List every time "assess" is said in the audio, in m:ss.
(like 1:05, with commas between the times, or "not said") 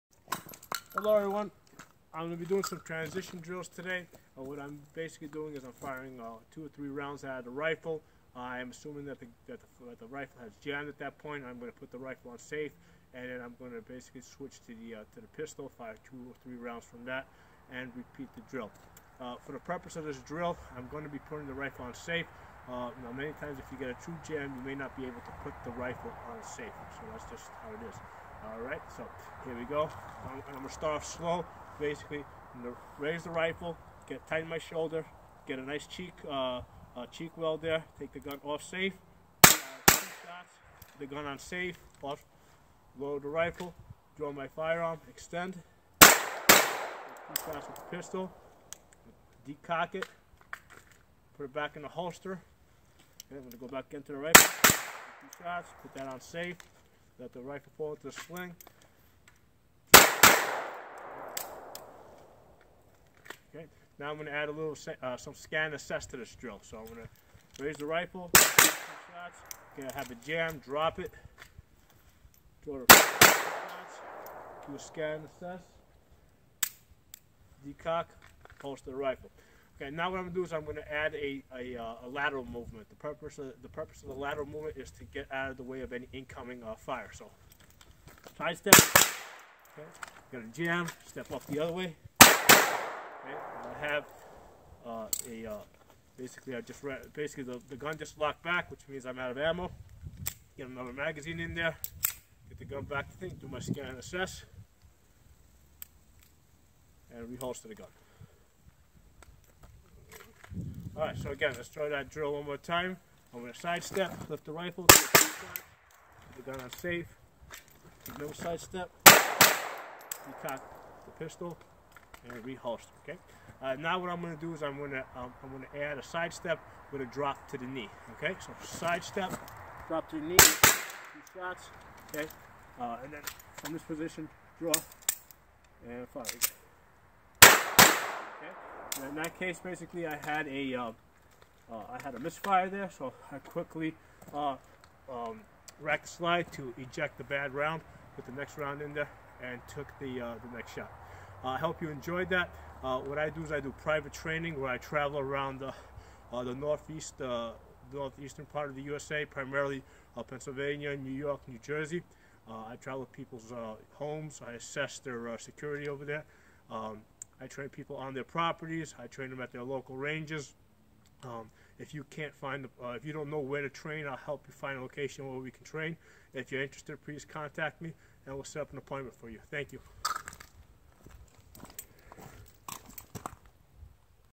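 1:05, 1:15, 1:43, 2:44.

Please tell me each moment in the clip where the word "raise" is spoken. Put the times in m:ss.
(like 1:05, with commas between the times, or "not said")
0:33, 1:07.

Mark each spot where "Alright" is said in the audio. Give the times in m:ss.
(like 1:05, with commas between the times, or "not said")
0:28, 1:51.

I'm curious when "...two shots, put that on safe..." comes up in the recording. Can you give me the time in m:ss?
0:55.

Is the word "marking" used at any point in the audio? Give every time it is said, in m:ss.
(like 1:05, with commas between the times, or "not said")
not said.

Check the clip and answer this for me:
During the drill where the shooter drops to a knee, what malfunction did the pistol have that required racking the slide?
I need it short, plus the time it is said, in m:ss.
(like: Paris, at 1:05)
A misfire, at 2:22.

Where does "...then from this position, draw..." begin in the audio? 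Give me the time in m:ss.
2:13.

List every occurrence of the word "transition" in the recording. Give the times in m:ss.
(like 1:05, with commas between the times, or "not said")
0:02.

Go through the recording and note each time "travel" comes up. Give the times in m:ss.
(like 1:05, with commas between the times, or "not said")
2:34, 2:42.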